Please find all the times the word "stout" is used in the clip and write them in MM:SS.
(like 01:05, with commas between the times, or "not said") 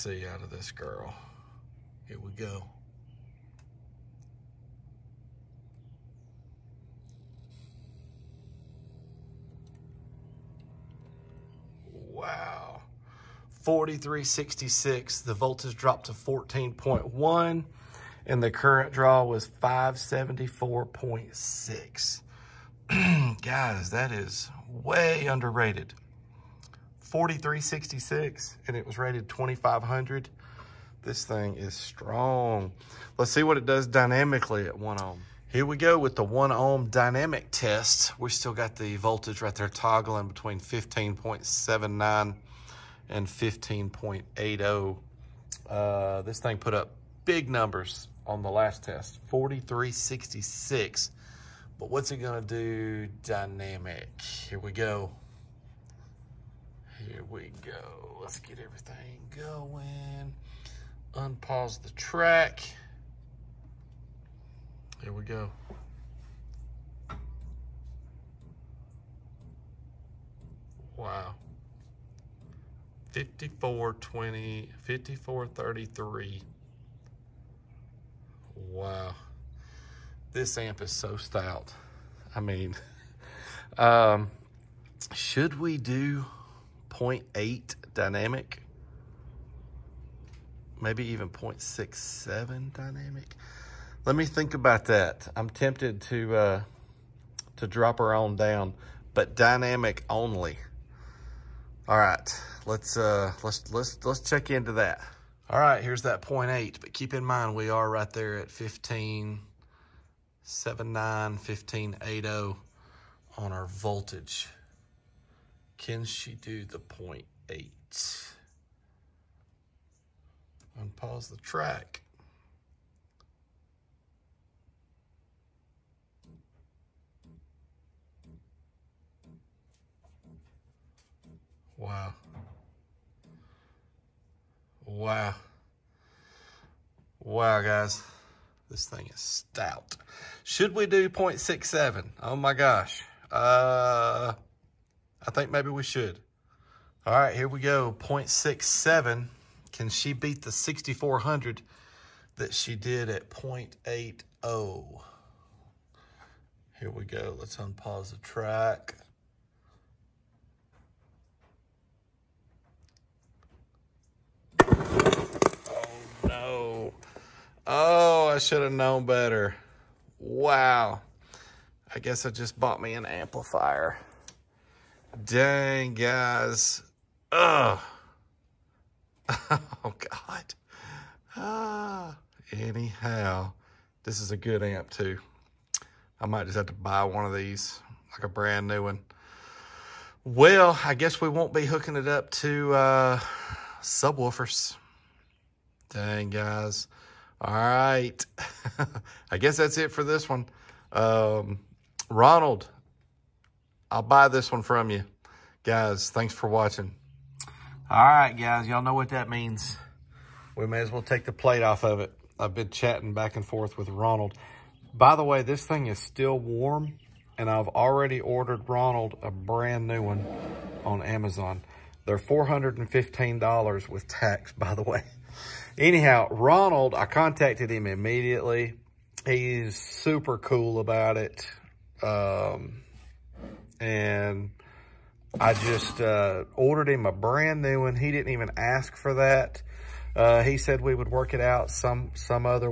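01:21, 02:19.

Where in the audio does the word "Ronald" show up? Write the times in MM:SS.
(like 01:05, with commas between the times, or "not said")
03:22, 03:33, 03:38, 03:46.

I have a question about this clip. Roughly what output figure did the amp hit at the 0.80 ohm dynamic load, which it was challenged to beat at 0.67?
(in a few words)
6,400.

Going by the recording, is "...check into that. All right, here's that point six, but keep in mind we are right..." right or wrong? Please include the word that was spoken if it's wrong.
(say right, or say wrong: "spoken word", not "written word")
wrong: "eight", not "six".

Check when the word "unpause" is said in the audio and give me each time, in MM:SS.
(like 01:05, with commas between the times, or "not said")
01:01, 02:00, 02:37.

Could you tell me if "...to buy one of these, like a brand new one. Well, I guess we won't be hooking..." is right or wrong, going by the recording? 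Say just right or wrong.
right.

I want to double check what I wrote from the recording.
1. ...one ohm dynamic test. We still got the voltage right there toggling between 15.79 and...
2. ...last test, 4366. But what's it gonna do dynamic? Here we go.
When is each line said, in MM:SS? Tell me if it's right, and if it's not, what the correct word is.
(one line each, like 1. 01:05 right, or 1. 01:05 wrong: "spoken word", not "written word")
1. 00:36 right
2. 00:48 right.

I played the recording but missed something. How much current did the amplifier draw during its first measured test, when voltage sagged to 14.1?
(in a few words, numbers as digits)
574.6.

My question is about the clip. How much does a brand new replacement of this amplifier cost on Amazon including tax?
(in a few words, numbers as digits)
$415.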